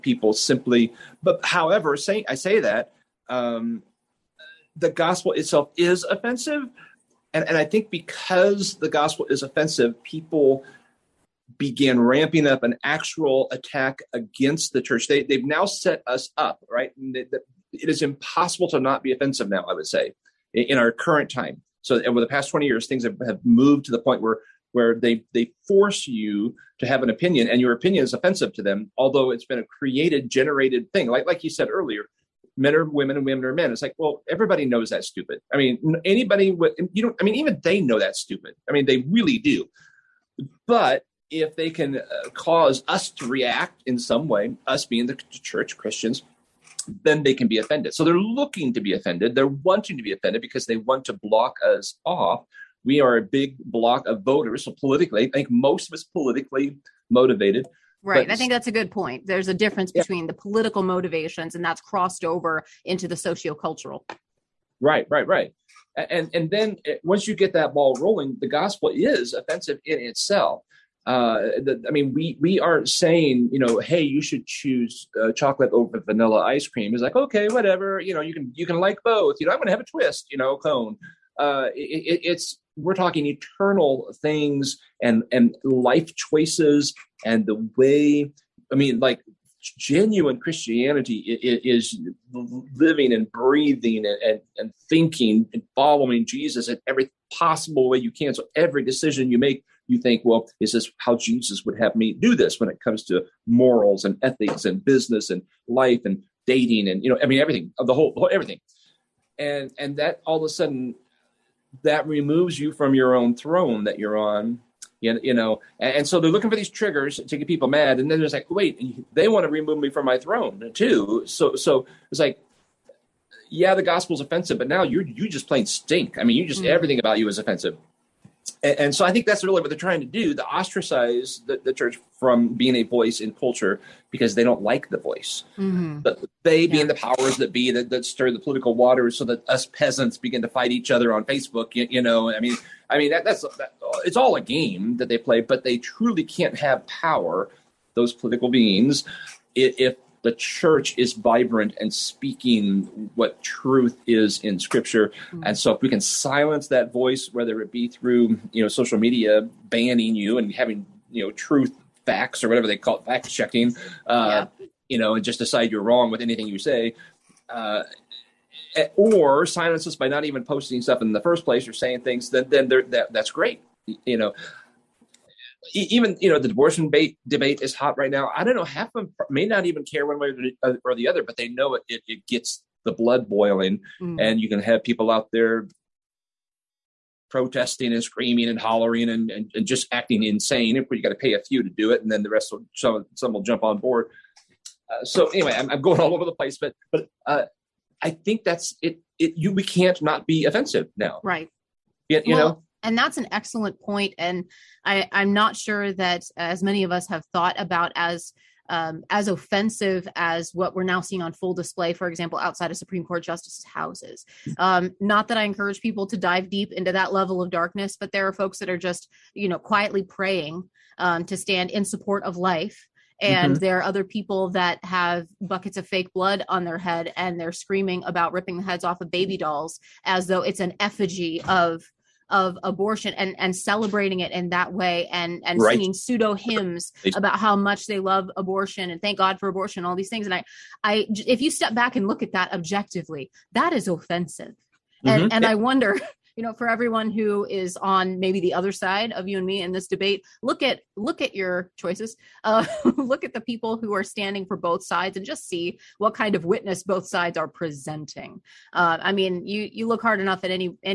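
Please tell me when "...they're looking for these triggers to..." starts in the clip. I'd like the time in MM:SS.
01:56.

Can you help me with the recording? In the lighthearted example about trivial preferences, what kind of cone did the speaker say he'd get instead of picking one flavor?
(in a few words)
A twist.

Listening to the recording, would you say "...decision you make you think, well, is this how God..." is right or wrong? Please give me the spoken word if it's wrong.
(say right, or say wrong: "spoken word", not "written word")
wrong: "Jesus", not "God".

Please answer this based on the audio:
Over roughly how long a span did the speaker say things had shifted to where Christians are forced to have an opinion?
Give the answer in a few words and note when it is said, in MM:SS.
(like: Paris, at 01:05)
20 years, at 00:22.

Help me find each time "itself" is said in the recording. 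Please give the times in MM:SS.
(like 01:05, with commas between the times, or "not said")
00:05, 01:09.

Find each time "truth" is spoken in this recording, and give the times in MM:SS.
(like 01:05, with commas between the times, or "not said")
02:33, 02:41.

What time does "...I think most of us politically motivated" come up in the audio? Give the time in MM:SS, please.
00:55.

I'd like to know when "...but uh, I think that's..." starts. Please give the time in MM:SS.
03:16.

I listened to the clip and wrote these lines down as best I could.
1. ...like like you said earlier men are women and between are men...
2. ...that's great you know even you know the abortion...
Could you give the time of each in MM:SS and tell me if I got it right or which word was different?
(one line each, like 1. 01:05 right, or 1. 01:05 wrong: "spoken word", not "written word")
1. 00:31 wrong: "women", not "between"
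2. 02:53 right.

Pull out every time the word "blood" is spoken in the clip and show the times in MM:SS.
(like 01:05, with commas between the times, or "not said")
03:02, 03:46.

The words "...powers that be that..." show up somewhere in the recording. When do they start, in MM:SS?
02:16.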